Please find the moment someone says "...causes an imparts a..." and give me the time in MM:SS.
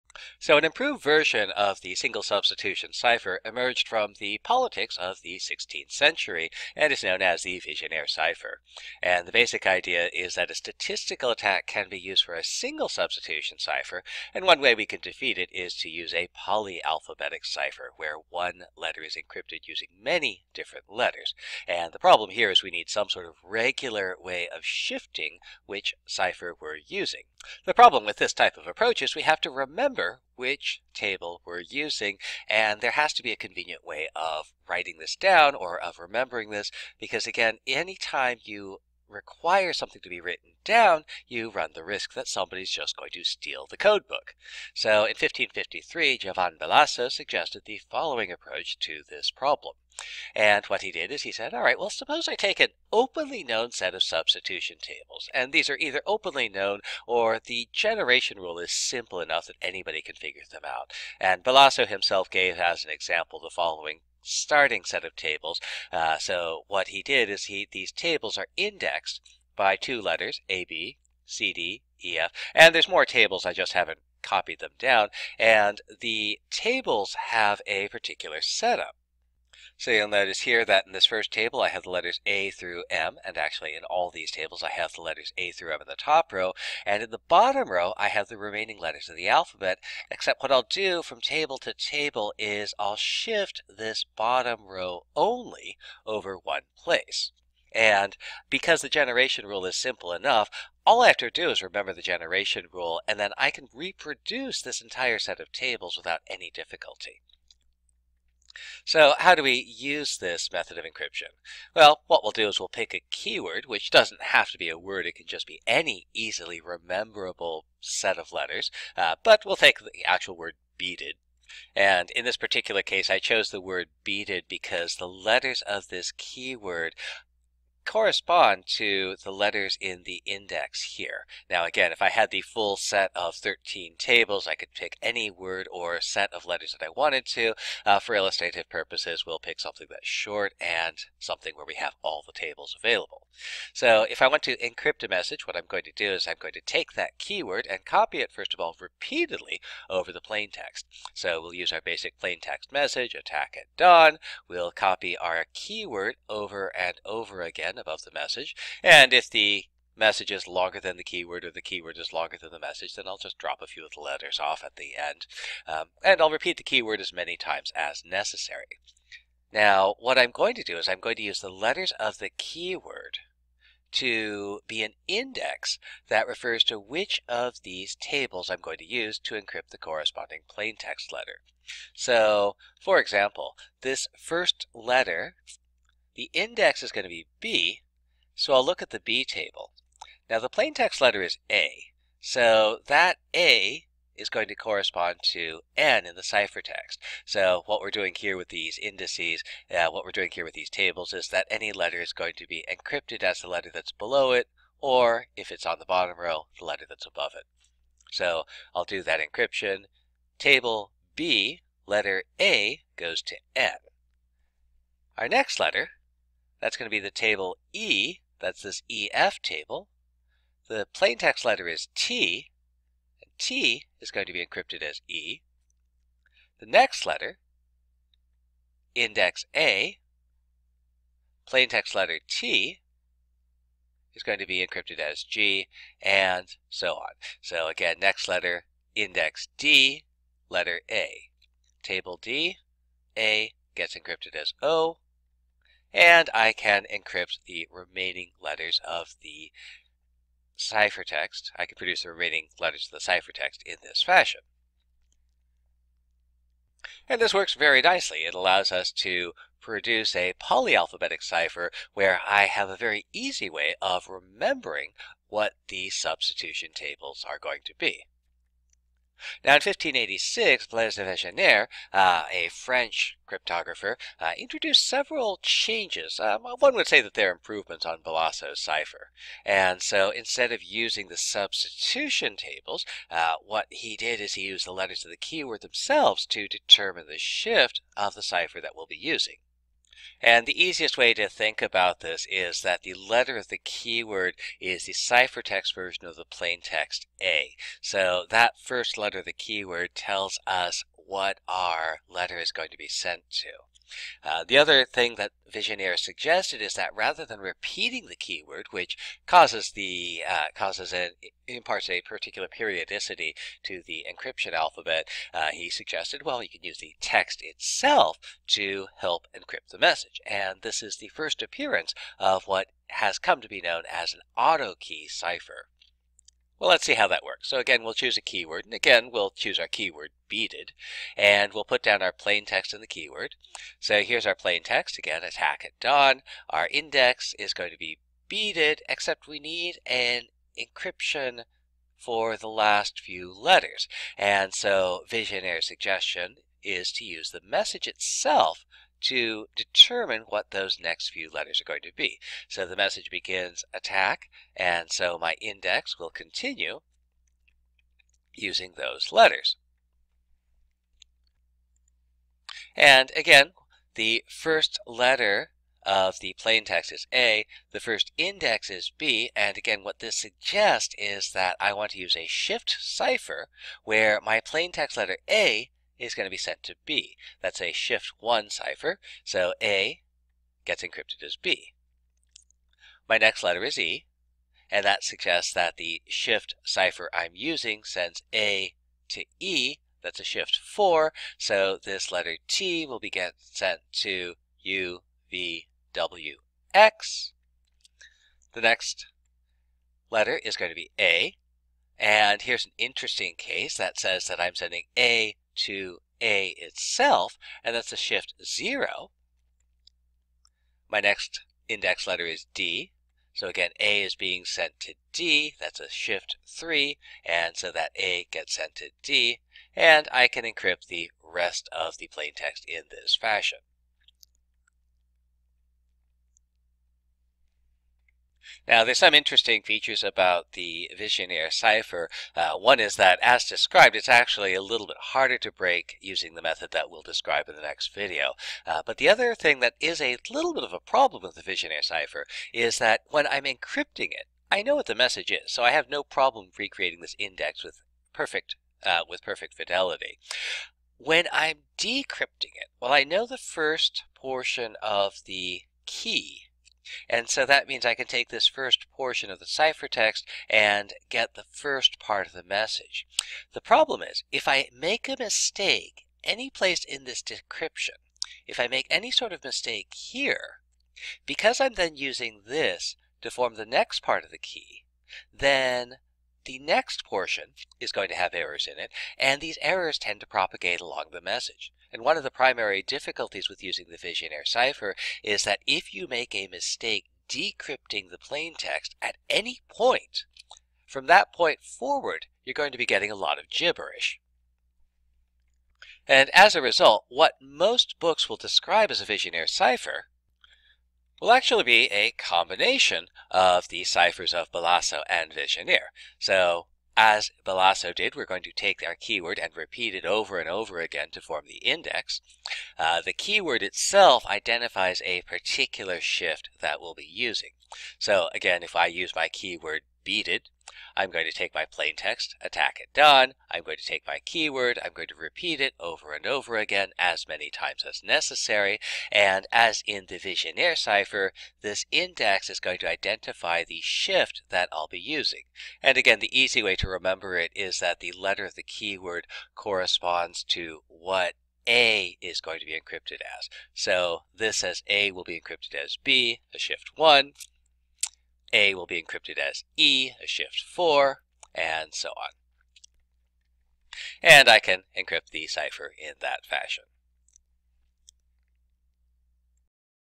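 05:10.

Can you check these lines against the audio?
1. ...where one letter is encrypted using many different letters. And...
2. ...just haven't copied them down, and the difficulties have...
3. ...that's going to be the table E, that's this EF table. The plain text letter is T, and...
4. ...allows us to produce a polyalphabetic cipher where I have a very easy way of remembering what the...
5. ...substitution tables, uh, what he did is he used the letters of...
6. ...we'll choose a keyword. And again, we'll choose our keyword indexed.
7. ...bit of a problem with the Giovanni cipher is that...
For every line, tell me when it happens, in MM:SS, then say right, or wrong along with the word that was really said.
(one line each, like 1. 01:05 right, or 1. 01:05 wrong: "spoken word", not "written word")
1. 00:17 right
2. 01:13 wrong: "tables", not "difficulties"
3. 03:36 right
4. 04:18 right
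5. 04:41 right
6. 05:27 wrong: "beaded", not "indexed"
7. 07:20 wrong: "Vigenère", not "Giovanni".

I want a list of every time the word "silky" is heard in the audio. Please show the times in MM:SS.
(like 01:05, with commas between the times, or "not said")
not said.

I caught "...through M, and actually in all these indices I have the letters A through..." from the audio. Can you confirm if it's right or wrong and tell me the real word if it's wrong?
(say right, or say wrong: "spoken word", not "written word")
wrong: "tables", not "indices".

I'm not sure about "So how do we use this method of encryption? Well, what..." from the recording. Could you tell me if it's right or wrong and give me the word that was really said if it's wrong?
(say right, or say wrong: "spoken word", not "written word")
right.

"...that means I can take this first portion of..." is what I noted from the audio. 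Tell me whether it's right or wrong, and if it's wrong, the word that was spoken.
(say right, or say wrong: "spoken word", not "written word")
right.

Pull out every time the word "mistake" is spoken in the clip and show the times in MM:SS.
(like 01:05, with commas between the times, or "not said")
07:45, 07:49, 08:06.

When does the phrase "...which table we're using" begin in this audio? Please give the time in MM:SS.
00:30.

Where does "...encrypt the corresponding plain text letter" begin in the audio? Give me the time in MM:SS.
02:59.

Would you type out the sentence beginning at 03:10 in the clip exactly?
Now the plain text letter is A, so that A is going to correspond to n in the ciphertext.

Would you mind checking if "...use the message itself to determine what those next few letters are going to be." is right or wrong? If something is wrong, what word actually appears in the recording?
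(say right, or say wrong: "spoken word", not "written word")
right.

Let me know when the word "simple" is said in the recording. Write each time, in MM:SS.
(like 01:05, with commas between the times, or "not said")
00:58, 01:39.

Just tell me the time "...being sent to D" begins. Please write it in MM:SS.
06:54.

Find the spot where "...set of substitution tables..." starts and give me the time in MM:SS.
00:53.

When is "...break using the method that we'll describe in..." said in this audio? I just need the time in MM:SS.
07:15.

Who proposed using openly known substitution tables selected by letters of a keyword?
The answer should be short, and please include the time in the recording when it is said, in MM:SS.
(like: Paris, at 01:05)
Giovanni Bellaso, at 00:46.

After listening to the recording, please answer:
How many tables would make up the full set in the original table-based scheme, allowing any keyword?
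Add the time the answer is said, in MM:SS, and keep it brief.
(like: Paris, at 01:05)
13, at 02:13.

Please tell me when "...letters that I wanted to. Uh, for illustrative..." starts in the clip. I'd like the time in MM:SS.
02:16.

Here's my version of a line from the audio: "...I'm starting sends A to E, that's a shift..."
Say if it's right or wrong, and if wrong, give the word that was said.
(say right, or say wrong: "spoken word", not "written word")
wrong: "using", not "starting".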